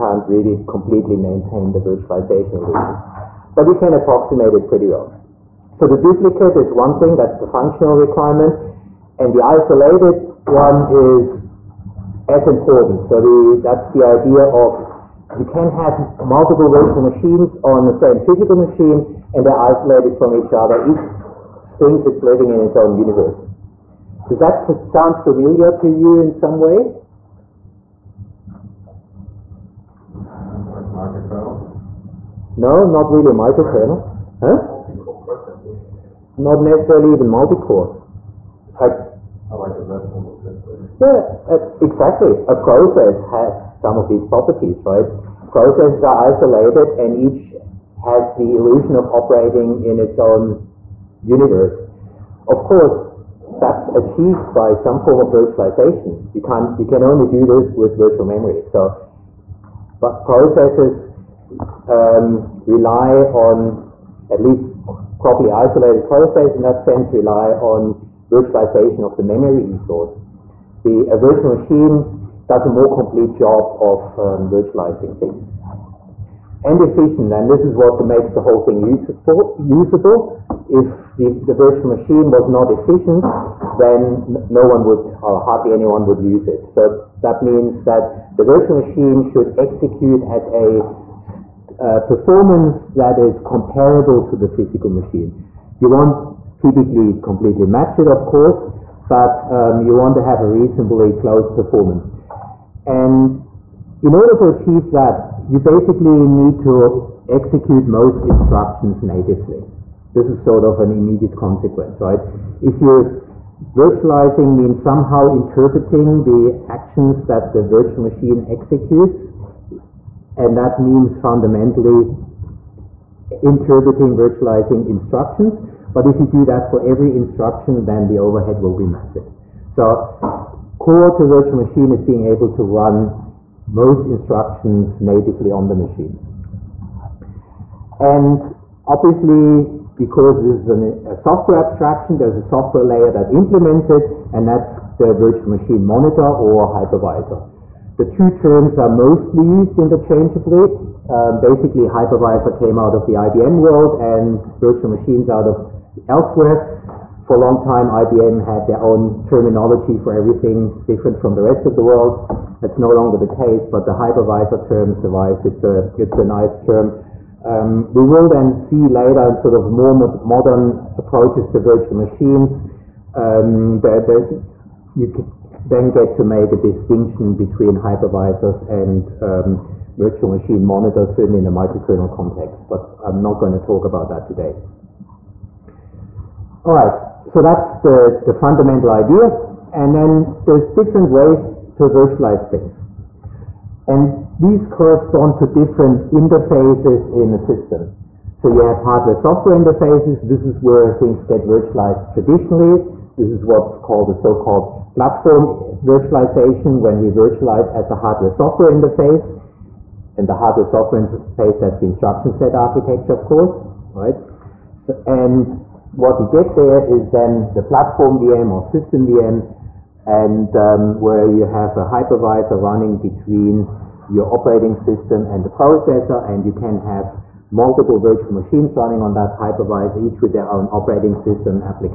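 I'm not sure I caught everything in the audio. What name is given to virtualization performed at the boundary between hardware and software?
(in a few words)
Platform virtualization.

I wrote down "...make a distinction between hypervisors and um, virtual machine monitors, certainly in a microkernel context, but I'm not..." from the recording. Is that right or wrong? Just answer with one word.
right.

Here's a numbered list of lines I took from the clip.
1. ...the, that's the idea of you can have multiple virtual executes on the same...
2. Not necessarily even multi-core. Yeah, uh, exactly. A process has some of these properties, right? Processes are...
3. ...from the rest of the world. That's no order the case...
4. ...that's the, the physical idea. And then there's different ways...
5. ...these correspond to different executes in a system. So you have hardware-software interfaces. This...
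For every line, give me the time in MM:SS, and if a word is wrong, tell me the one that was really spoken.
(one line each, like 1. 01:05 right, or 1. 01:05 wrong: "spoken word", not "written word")
1. 00:13 wrong: "machines", not "executes"
2. 00:36 right
3. 02:41 wrong: "longer", not "order"
4. 03:07 wrong: "fundamental", not "physical"
5. 03:14 wrong: "interfaces", not "executes".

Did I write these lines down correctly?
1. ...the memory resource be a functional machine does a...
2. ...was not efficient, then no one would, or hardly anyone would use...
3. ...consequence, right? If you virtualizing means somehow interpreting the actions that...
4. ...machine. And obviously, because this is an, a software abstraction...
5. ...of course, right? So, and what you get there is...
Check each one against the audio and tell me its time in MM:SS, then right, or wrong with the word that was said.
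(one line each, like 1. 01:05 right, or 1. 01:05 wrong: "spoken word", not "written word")
1. 01:09 wrong: "virtual", not "functional"
2. 01:22 right
3. 01:51 right
4. 02:15 right
5. 03:33 right.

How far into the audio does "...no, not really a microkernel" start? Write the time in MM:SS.
00:32.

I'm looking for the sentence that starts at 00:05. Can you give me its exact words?
So the duplicate is one thing, that's the functional requirement.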